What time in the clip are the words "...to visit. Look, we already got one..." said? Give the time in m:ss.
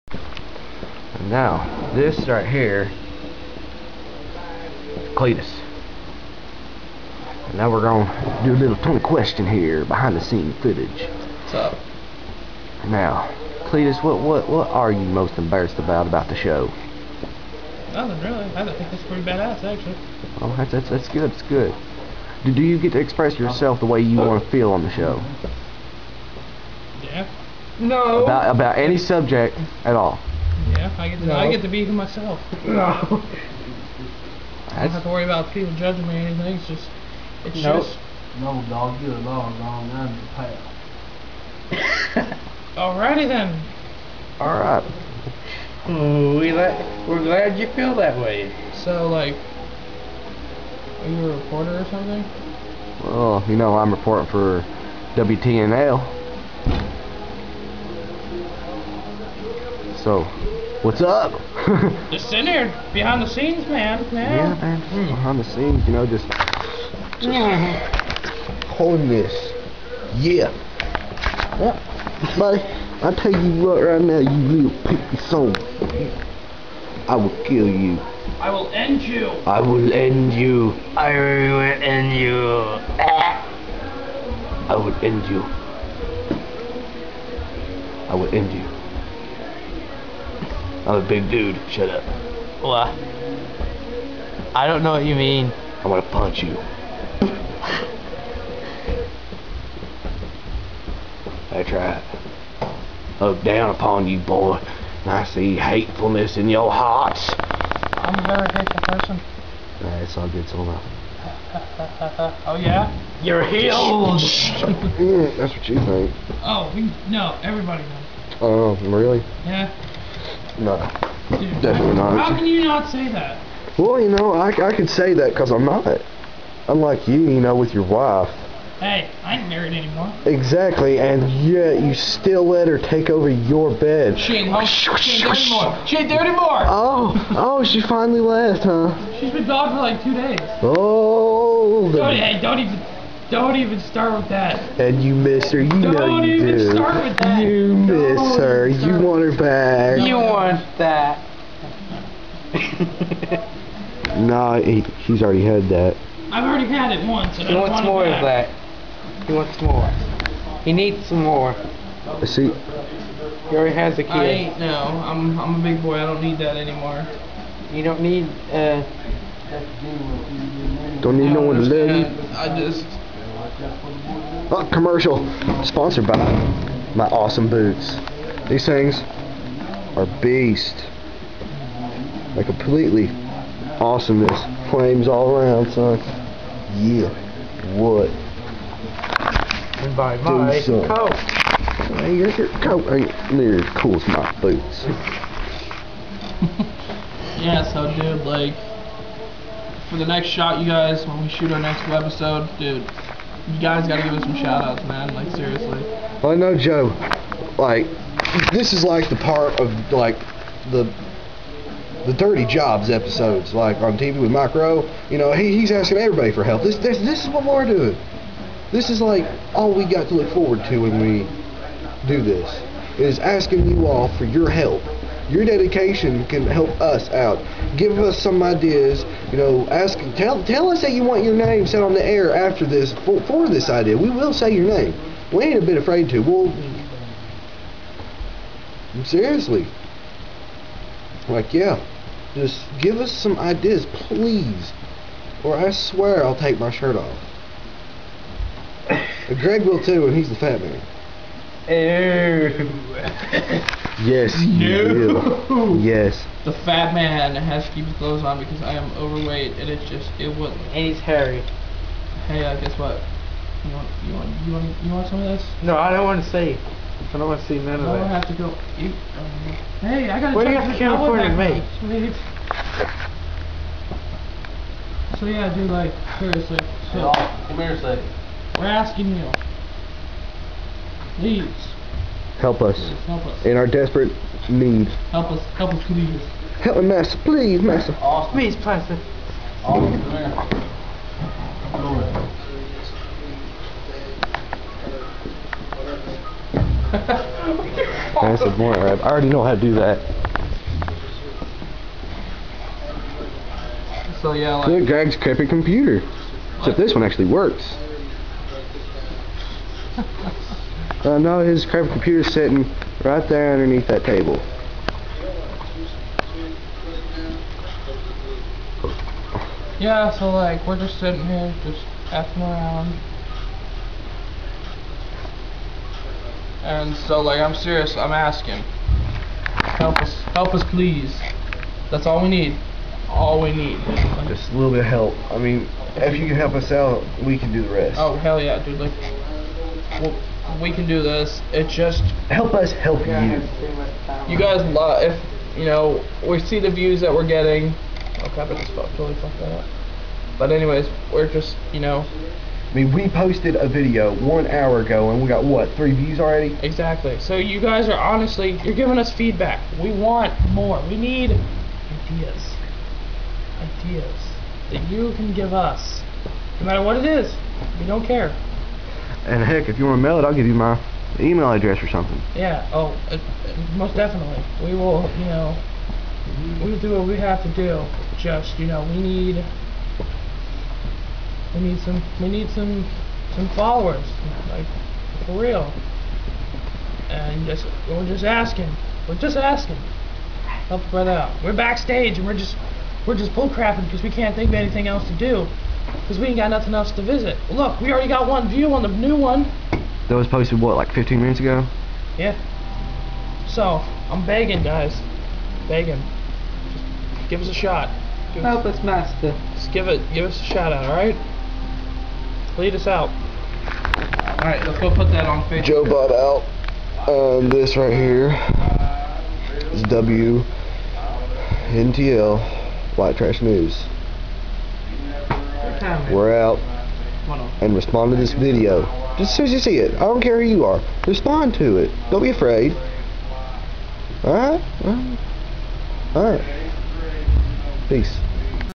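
6:36.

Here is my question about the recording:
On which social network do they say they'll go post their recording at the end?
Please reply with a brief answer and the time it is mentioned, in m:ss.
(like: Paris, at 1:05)
Facebook, at 6:55.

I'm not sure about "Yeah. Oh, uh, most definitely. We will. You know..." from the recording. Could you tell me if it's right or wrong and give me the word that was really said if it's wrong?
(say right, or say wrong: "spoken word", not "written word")
right.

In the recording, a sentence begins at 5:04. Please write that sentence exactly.
So yeah, like Look, Greg's crappy computer.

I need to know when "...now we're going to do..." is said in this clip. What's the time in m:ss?
0:07.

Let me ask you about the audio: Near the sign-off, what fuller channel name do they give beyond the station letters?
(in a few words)
White Trash News.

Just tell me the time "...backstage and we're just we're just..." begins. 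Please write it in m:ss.
6:31.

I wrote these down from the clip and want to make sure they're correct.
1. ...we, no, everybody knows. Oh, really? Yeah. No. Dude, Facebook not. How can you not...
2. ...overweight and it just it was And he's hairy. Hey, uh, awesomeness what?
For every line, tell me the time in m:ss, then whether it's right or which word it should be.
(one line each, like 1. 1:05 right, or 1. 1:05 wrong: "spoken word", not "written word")
1. 1:56 wrong: "Definitely", not "Facebook"
2. 4:18 wrong: "guess", not "awesomeness".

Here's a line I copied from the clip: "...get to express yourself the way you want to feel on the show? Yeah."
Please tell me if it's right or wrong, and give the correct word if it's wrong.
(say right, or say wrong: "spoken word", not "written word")
right.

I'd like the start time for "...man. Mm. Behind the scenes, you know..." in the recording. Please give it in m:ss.
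1:04.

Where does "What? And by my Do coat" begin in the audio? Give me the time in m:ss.
3:07.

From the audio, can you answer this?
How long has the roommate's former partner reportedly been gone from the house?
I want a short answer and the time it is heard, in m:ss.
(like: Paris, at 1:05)
two days, at 2:19.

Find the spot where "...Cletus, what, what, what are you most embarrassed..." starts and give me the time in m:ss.
0:13.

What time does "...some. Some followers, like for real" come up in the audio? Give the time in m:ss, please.
6:22.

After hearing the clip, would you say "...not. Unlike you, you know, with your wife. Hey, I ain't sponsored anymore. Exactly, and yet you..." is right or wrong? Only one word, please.
wrong.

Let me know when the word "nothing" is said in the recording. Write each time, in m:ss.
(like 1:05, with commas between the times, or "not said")
0:17, 6:36.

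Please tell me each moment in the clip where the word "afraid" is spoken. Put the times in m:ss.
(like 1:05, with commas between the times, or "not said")
3:55, 7:12.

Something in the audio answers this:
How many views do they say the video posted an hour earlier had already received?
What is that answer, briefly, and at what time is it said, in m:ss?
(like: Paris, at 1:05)
3, at 5:55.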